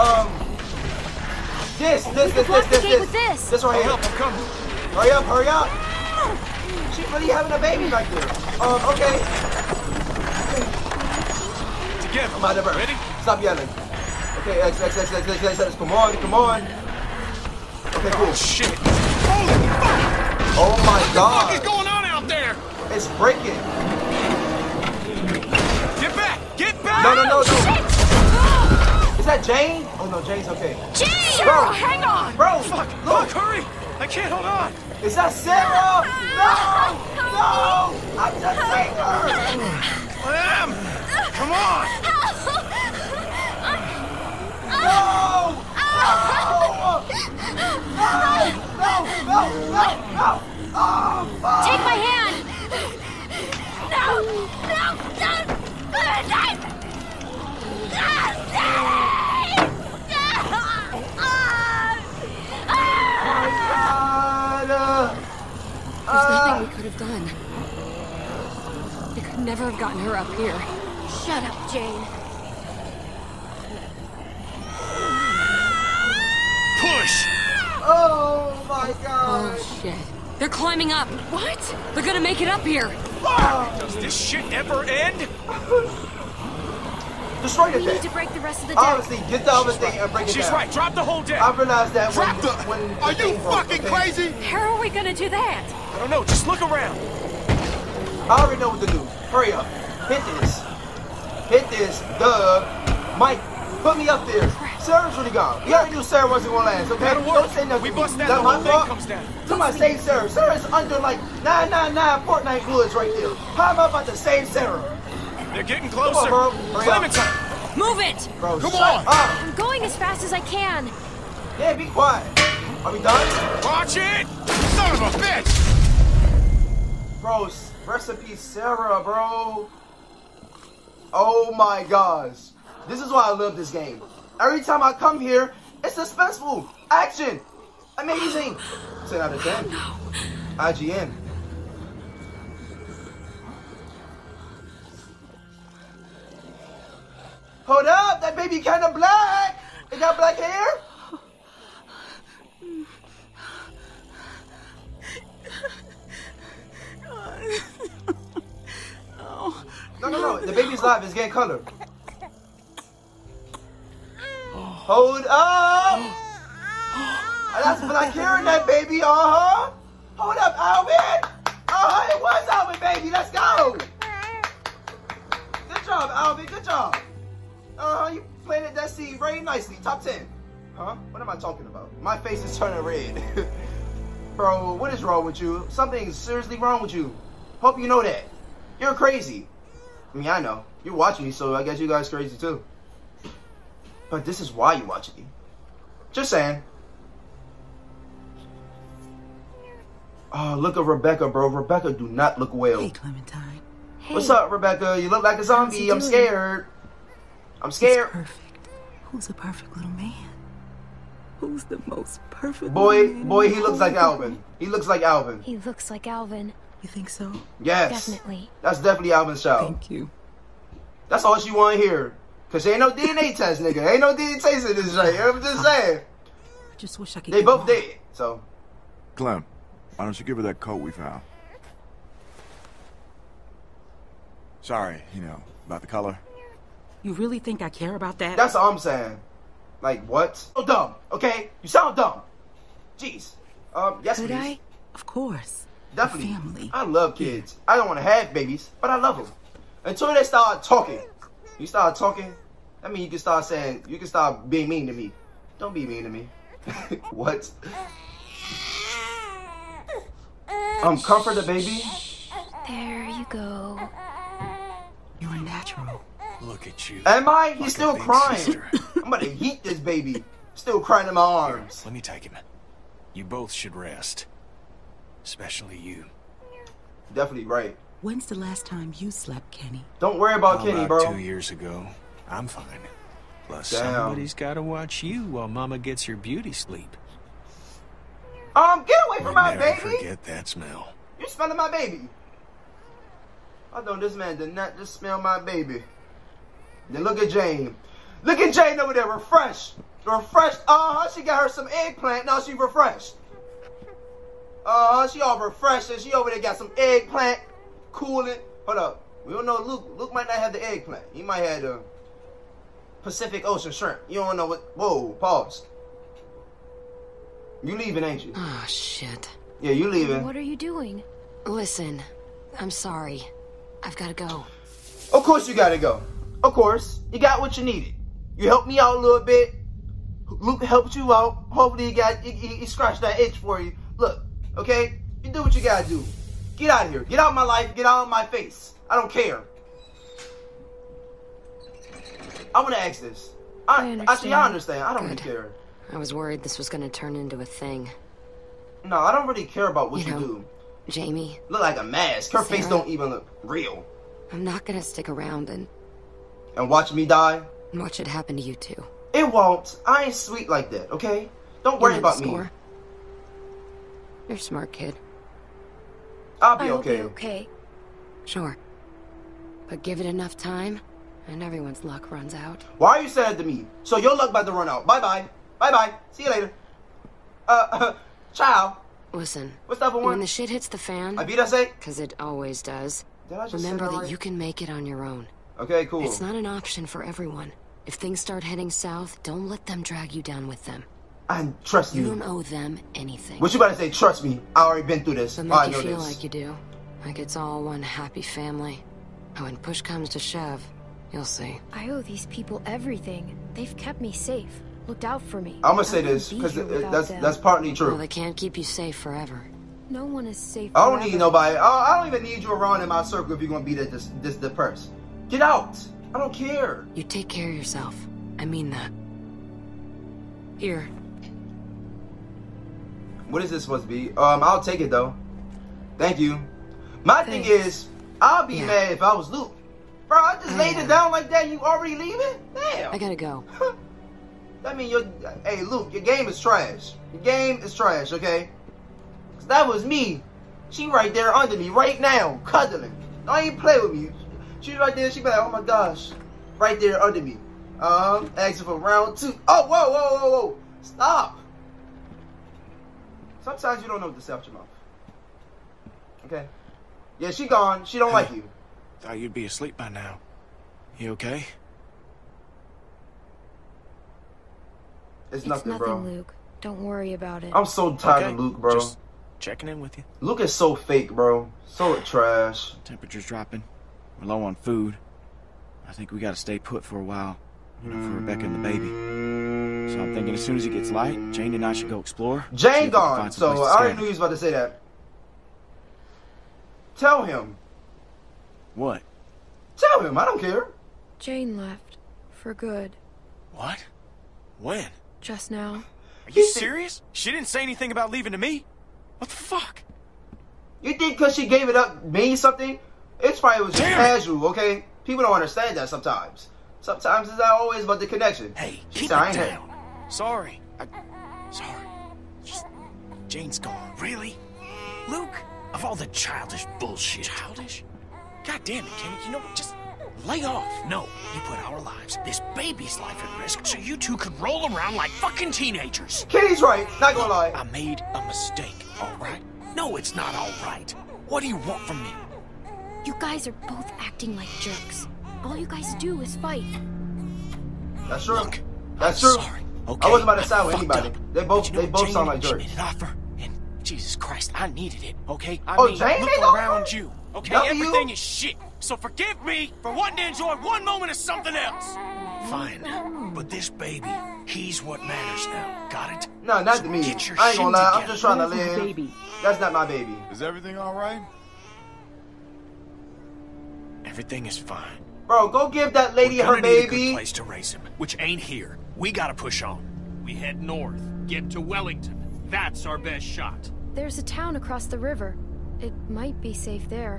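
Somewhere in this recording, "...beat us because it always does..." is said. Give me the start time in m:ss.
6:21.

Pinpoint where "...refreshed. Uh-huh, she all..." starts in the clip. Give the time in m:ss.
5:02.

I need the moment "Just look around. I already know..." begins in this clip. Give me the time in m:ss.
1:36.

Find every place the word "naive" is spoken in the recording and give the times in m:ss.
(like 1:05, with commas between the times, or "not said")
not said.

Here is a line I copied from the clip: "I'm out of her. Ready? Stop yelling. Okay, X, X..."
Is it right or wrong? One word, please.
right.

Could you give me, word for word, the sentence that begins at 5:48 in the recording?
No, I don't really care about what you, you know, do.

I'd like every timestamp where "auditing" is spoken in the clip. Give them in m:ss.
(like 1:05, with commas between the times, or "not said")
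not said.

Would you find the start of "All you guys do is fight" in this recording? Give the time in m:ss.
8:55.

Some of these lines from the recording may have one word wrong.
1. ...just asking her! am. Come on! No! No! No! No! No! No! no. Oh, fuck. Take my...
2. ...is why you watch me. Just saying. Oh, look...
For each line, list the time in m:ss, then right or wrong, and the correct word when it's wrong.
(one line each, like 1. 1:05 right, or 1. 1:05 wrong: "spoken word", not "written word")
1. 0:38 wrong: "seeing", not "asking"
2. 3:14 right.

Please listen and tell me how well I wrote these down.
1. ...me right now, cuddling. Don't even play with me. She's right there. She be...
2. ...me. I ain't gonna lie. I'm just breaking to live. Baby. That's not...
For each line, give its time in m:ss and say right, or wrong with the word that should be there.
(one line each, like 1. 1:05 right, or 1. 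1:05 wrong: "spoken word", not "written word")
1. 7:21 right
2. 9:16 wrong: "trying", not "breaking".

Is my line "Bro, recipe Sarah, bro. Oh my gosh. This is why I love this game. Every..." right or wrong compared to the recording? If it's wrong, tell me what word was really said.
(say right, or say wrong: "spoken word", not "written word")
right.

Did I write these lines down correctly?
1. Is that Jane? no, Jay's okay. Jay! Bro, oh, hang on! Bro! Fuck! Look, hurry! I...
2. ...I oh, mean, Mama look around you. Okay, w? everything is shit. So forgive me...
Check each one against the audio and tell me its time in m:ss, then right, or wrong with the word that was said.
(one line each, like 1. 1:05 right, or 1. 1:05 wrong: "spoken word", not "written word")
1. 0:29 right
2. 9:05 wrong: "Jane", not "Mama".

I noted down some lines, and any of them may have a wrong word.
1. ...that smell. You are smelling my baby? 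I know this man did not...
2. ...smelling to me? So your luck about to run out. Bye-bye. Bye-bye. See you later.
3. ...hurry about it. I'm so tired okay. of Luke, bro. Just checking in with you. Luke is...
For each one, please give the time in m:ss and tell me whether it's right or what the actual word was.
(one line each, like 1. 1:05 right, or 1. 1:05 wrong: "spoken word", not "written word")
1. 4:50 right
2. 6:13 wrong: "saying", not "smelling"
3. 7:46 wrong: "worry", not "hurry".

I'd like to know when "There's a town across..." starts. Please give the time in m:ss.
9:33.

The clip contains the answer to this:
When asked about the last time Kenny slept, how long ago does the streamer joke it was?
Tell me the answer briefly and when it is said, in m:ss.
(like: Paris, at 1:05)
Two years ago, at 4:41.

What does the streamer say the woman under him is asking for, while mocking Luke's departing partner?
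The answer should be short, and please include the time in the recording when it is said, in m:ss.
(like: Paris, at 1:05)
round two, at 7:28.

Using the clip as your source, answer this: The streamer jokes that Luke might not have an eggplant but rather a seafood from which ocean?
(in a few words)
Pacific.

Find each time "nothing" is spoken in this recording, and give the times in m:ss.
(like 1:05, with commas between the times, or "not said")
1:47, 7:45.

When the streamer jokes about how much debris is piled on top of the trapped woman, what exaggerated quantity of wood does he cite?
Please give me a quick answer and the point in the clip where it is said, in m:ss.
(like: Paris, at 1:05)
999, at 1:51.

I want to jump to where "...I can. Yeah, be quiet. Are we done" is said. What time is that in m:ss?
2:00.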